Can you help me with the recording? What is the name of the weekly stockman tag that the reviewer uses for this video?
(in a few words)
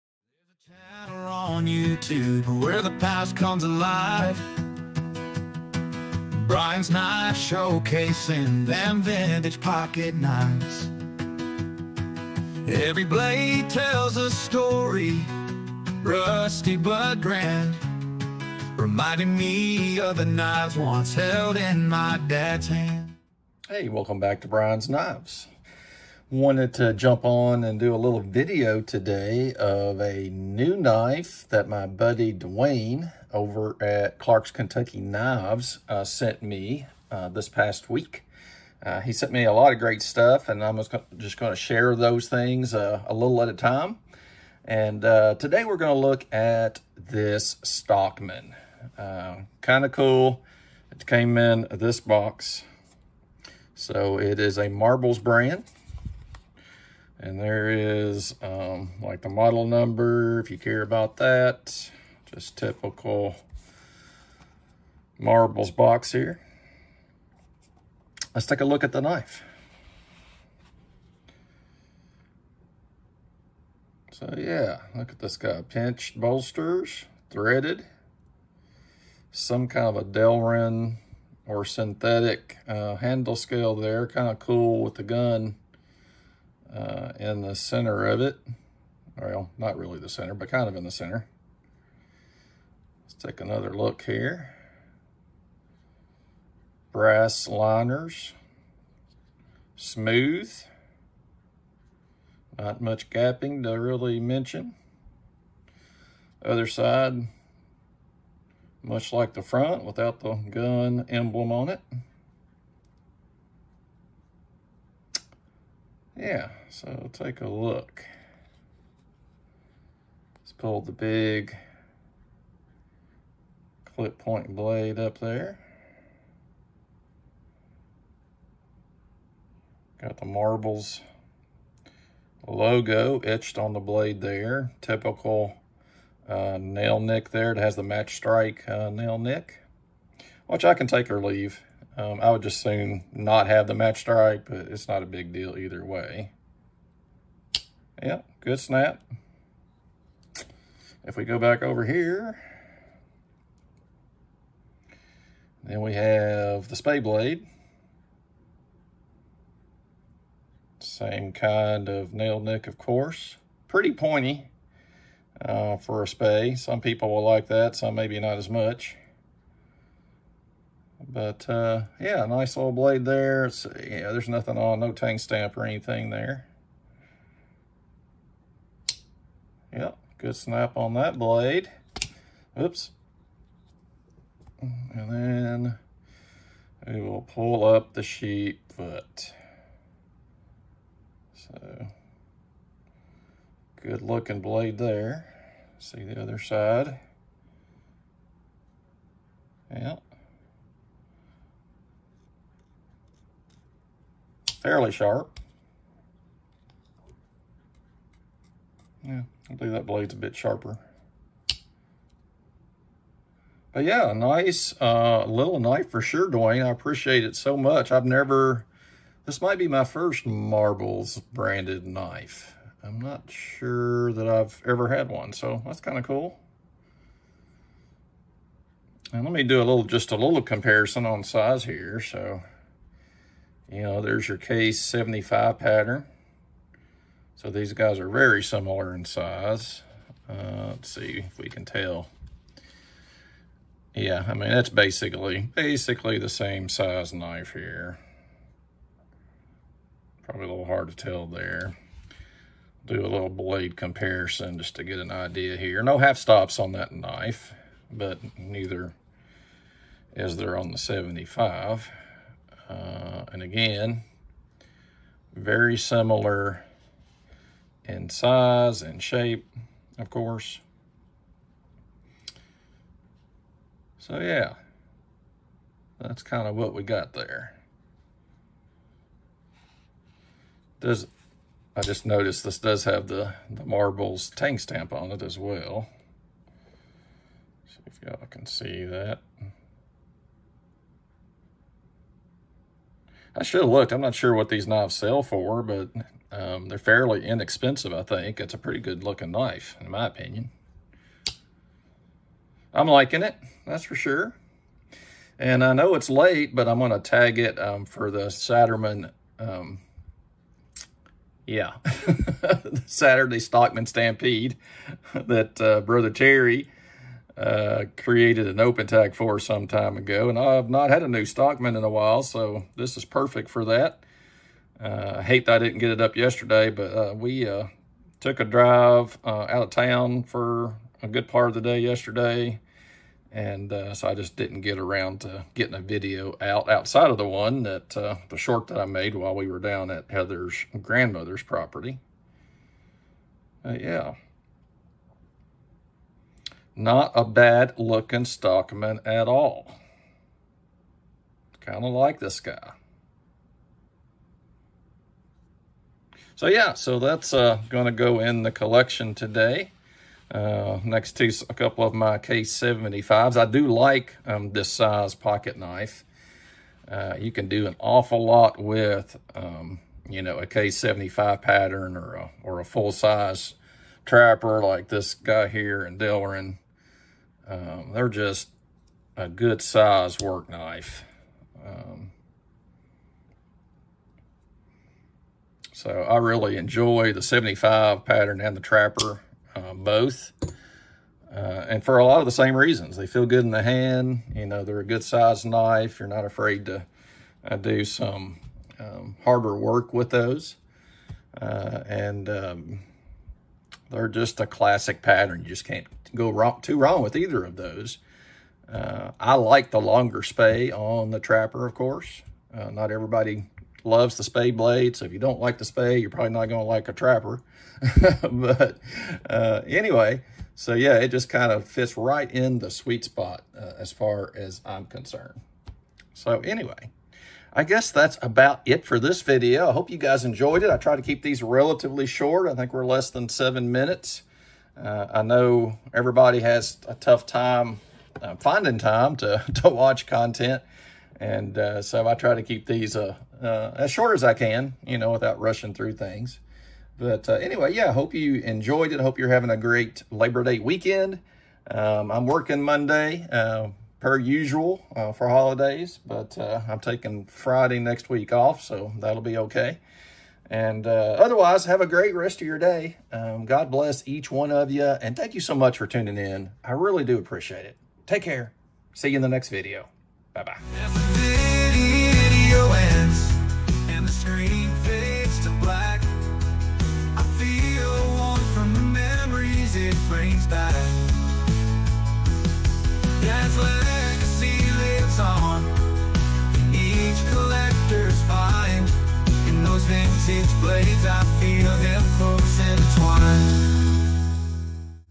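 Saturday Stockman Stampede.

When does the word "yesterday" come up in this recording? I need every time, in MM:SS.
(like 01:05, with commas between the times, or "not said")
05:26, 05:31.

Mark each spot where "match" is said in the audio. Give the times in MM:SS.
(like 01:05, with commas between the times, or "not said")
02:17, 02:23.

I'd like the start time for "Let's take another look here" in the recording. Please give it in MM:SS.
01:33.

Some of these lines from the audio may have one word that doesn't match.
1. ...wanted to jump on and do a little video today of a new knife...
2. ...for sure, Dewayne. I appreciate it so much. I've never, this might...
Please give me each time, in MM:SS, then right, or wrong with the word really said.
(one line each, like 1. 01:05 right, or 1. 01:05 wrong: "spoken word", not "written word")
1. 00:26 right
2. 03:35 right.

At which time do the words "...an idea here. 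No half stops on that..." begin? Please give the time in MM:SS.
04:14.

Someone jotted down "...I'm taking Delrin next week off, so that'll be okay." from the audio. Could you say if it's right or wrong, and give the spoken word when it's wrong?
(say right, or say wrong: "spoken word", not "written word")
wrong: "Friday", not "Delrin".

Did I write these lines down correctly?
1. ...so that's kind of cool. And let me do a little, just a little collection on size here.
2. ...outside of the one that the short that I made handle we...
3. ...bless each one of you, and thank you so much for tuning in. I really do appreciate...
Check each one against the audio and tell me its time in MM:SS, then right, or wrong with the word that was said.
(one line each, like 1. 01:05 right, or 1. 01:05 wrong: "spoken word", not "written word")
1. 03:45 wrong: "comparison", not "collection"
2. 05:36 wrong: "while", not "handle"
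3. 07:43 right.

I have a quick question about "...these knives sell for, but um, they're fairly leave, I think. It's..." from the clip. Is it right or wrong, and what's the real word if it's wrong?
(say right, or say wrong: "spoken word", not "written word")
wrong: "inexpensive", not "leave".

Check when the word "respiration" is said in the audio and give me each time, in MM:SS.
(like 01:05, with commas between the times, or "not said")
not said.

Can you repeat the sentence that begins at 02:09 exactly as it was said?
Got the marbles logo etched on the blade there.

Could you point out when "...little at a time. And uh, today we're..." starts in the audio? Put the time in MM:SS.
00:43.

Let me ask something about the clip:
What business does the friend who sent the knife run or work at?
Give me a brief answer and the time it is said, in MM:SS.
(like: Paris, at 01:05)
Clark's Kentucky Knives, at 00:34.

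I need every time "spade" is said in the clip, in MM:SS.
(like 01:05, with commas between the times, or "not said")
02:36, 02:46.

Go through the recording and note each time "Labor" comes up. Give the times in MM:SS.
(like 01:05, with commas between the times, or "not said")
07:30.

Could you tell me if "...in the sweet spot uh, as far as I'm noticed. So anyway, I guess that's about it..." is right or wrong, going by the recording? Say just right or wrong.
wrong.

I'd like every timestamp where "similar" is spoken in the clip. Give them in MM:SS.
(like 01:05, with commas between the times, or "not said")
03:58, 04:25.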